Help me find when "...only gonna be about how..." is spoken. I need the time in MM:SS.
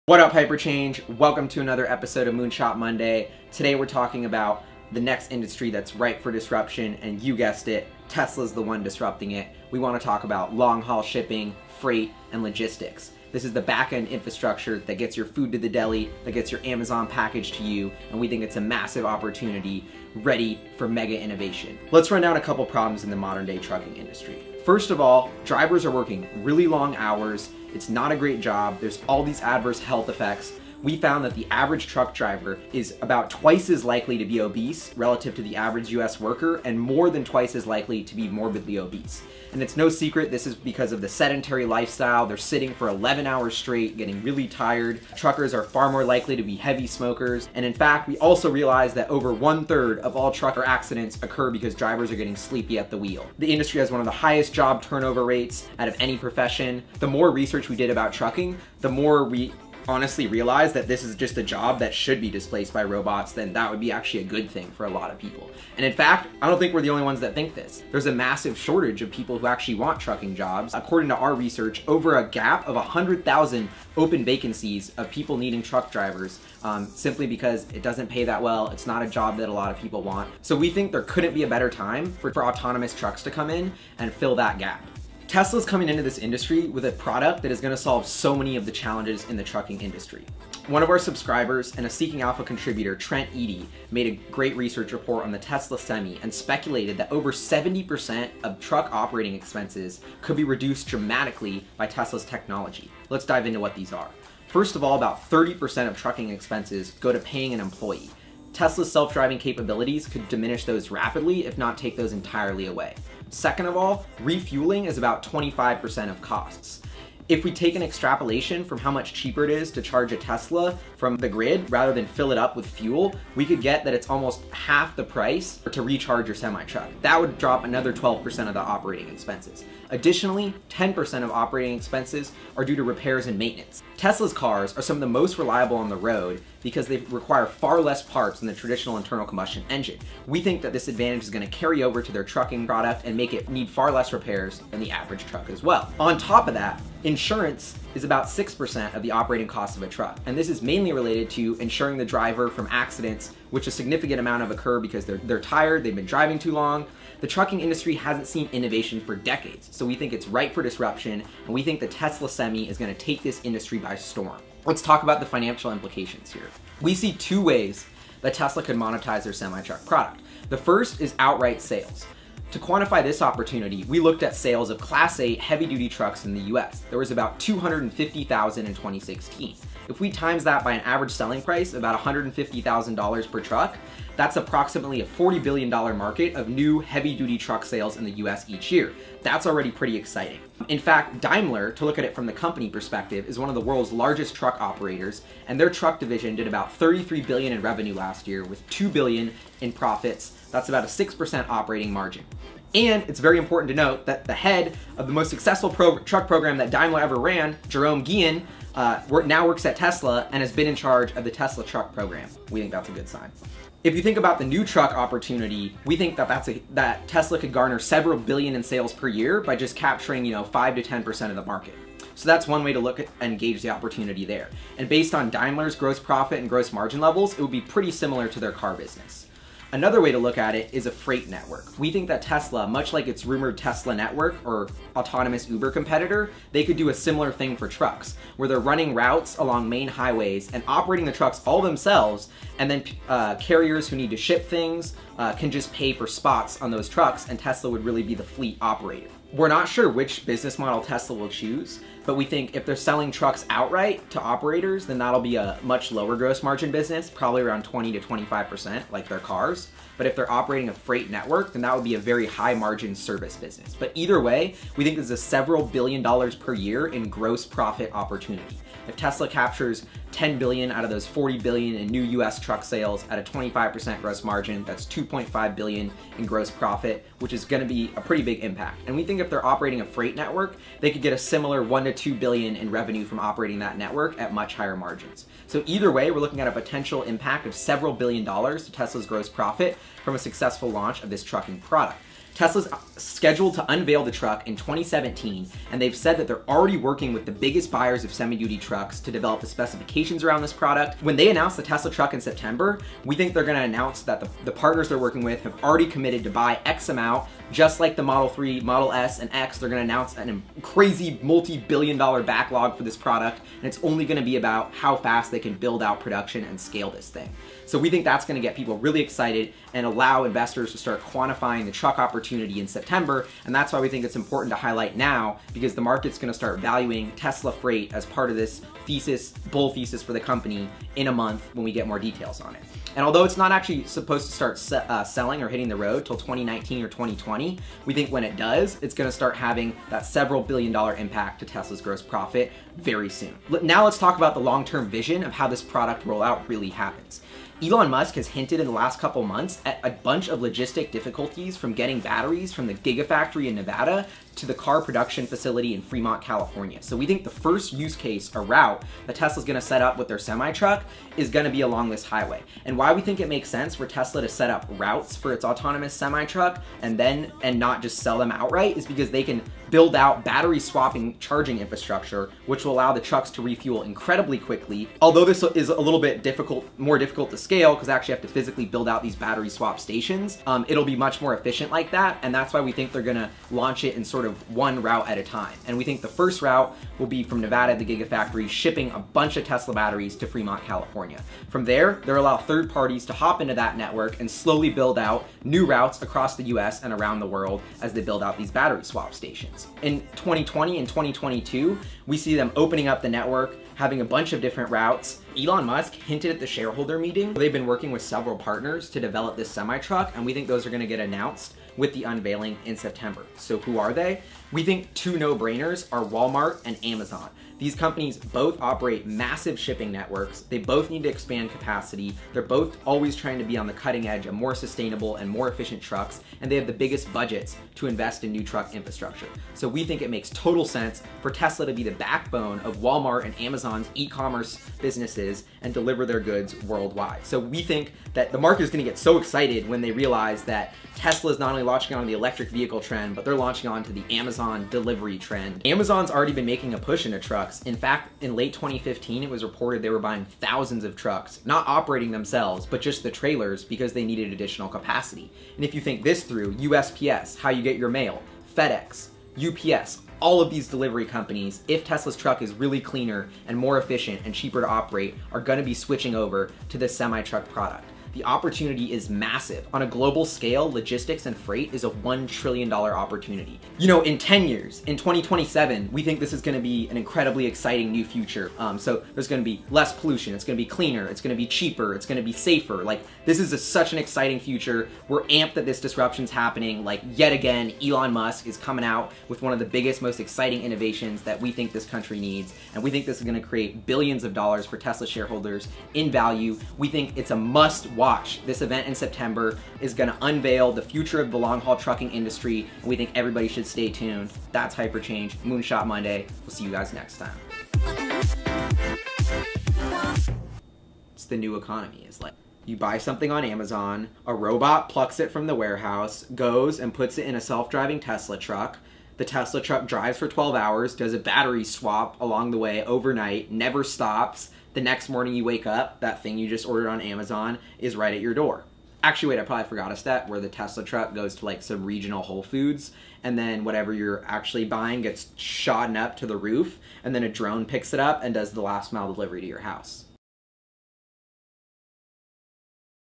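05:13.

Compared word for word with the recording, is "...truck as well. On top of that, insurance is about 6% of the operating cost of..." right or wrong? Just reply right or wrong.
right.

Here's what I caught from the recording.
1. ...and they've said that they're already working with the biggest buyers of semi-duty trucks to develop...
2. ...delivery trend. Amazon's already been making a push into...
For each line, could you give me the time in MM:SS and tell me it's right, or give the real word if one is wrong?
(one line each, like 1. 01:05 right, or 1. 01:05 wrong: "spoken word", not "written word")
1. 04:55 right
2. 07:24 right.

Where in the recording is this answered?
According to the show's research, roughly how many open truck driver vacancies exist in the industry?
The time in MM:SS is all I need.
01:12.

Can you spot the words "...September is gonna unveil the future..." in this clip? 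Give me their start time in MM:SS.
08:18.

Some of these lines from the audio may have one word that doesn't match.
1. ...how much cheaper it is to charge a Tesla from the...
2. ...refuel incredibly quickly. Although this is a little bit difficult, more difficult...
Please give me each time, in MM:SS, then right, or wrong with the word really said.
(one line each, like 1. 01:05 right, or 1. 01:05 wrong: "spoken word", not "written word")
1. 01:58 right
2. 06:13 right.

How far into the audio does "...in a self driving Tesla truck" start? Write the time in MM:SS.
08:37.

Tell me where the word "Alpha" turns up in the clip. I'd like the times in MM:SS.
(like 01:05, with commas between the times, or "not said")
01:32.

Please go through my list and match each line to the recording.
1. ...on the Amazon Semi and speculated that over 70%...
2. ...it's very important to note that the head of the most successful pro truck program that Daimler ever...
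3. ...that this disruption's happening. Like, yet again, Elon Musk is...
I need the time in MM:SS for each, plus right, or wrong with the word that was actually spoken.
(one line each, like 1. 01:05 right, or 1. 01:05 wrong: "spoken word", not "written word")
1. 01:35 wrong: "Tesla", not "Amazon"
2. 03:23 right
3. 08:05 right.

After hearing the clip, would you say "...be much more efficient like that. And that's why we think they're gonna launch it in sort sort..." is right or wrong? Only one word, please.
right.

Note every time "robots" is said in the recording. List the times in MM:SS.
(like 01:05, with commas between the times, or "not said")
01:02, 08:34.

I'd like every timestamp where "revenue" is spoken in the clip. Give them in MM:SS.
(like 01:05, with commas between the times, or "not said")
03:17, 04:42.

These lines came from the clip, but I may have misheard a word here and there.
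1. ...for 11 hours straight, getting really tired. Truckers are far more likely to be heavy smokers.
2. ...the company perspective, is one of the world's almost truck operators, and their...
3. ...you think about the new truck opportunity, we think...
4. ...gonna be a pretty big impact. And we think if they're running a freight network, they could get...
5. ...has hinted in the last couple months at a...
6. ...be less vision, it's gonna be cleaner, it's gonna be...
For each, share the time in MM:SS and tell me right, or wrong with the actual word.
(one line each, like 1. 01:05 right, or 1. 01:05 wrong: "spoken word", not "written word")
1. 00:42 right
2. 03:12 wrong: "largest", not "almost"
3. 03:33 right
4. 04:37 wrong: "operating", not "running"
5. 05:48 right
6. 07:59 wrong: "pollution", not "vision".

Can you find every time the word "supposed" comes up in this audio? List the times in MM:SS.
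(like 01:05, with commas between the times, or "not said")
05:33.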